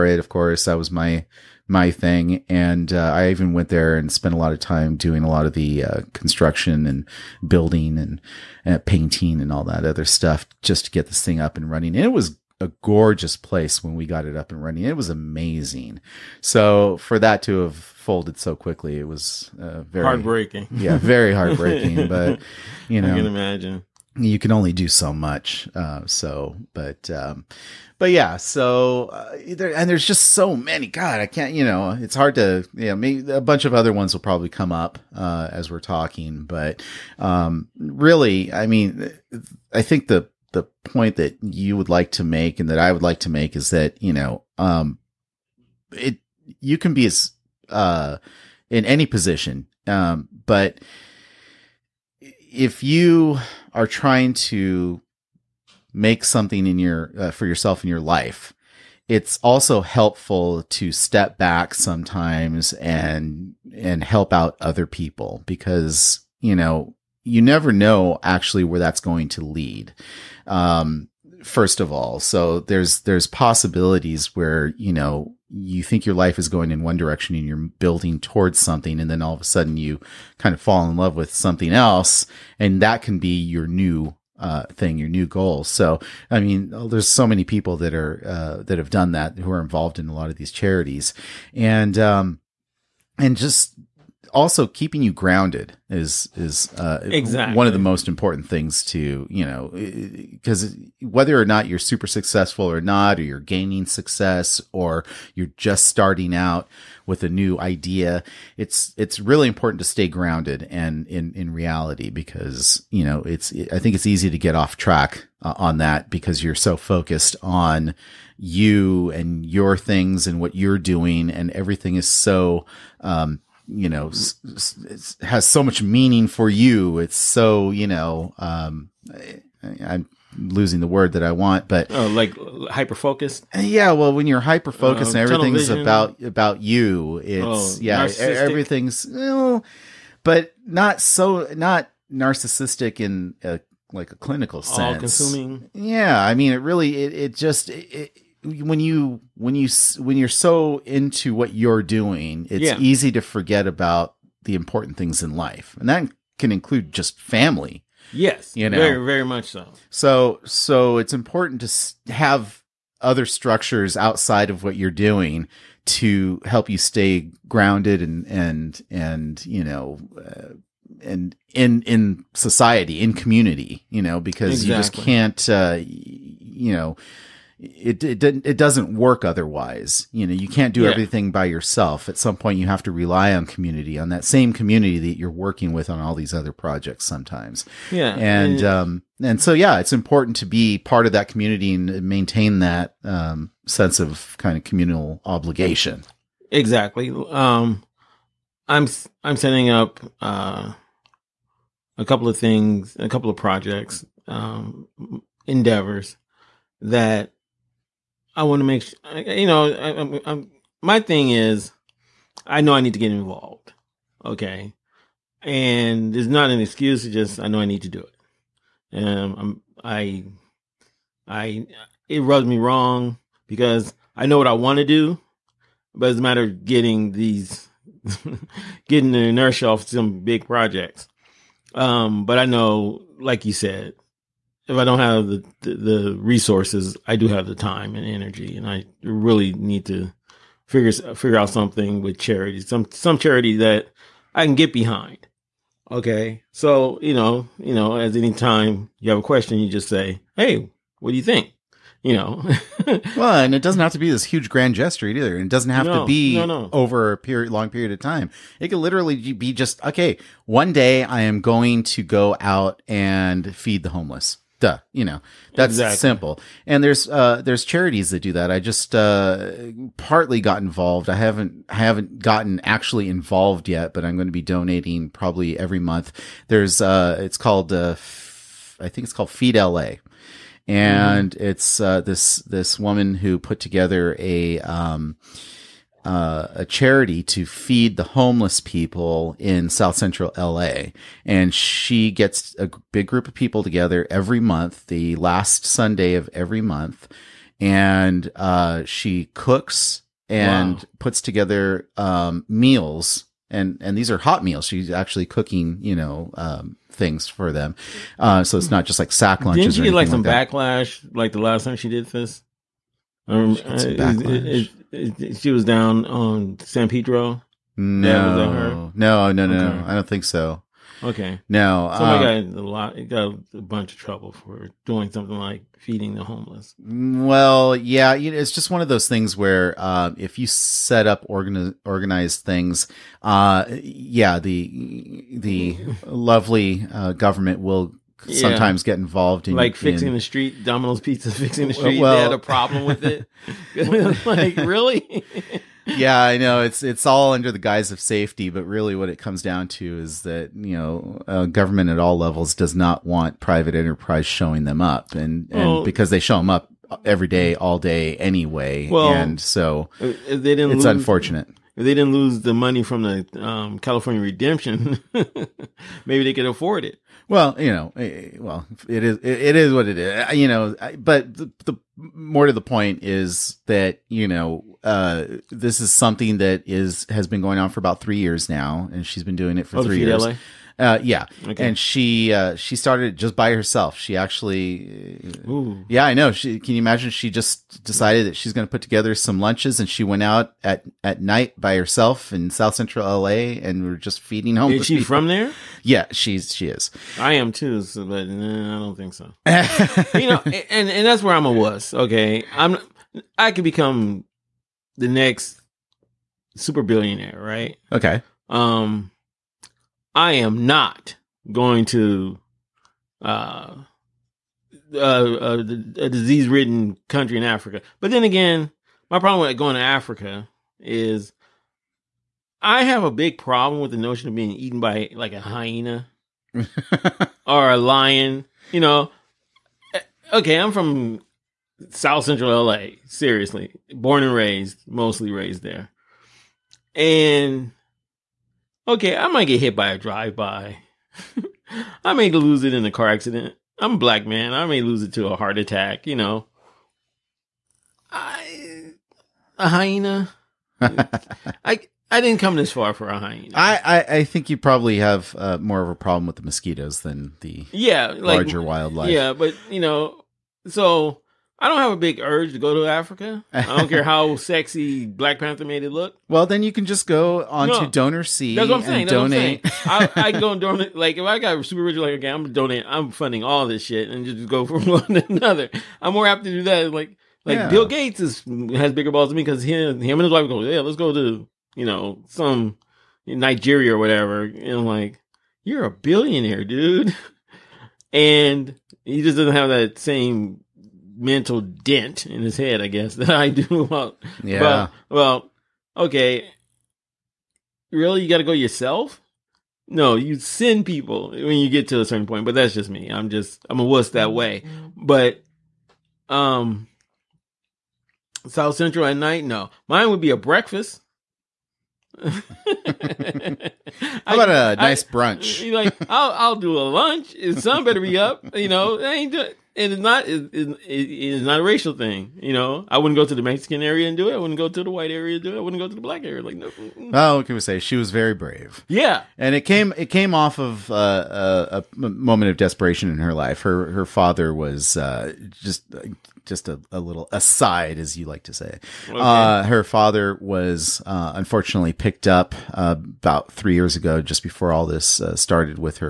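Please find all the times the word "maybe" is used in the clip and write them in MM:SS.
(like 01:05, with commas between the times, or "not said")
00:32, 06:06.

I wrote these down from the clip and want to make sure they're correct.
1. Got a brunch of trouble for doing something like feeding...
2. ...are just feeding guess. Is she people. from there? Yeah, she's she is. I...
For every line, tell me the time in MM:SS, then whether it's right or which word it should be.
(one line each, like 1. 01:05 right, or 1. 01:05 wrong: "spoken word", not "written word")
1. 05:23 wrong: "bunch", not "brunch"
2. 06:33 wrong: "homeless", not "guess".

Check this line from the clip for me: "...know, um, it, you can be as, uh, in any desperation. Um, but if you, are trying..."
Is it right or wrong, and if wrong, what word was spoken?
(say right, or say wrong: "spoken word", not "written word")
wrong: "position", not "desperation".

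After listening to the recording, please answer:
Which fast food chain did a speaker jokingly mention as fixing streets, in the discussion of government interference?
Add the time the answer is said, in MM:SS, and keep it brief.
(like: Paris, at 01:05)
Domino's Pizza, at 05:40.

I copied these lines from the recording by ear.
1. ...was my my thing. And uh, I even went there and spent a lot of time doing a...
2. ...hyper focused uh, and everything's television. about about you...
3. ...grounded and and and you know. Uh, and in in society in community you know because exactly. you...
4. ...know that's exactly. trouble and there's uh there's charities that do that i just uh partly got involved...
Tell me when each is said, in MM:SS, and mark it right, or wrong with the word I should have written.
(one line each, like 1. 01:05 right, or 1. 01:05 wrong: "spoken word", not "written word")
1. 00:00 right
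2. 02:14 right
3. 02:47 right
4. 04:25 wrong: "simple", not "trouble".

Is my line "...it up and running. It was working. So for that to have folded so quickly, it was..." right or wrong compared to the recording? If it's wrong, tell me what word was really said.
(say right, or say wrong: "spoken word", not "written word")
wrong: "amazing", not "working".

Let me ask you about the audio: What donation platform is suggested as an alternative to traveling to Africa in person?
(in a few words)
DonorSee.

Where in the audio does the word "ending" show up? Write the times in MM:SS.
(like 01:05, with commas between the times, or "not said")
not said.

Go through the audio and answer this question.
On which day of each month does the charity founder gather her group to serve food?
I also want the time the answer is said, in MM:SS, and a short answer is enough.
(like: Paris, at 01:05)
last Sunday, at 04:54.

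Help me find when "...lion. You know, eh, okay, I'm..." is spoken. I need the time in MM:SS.
07:07.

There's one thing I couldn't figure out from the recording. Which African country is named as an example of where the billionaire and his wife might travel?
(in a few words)
Nigeria.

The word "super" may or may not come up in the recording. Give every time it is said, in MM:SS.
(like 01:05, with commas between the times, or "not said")
01:41, 06:46, 07:51.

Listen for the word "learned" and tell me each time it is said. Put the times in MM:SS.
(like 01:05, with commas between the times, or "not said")
not said.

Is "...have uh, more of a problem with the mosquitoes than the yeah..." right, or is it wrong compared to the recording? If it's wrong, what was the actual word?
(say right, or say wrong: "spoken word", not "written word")
right.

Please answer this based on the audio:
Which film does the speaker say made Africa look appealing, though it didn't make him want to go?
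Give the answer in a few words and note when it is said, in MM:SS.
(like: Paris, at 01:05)
Black Panther, at 07:45.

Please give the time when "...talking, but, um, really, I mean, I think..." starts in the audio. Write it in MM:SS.
00:35.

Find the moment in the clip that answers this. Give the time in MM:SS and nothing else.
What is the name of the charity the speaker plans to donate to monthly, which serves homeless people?
04:39.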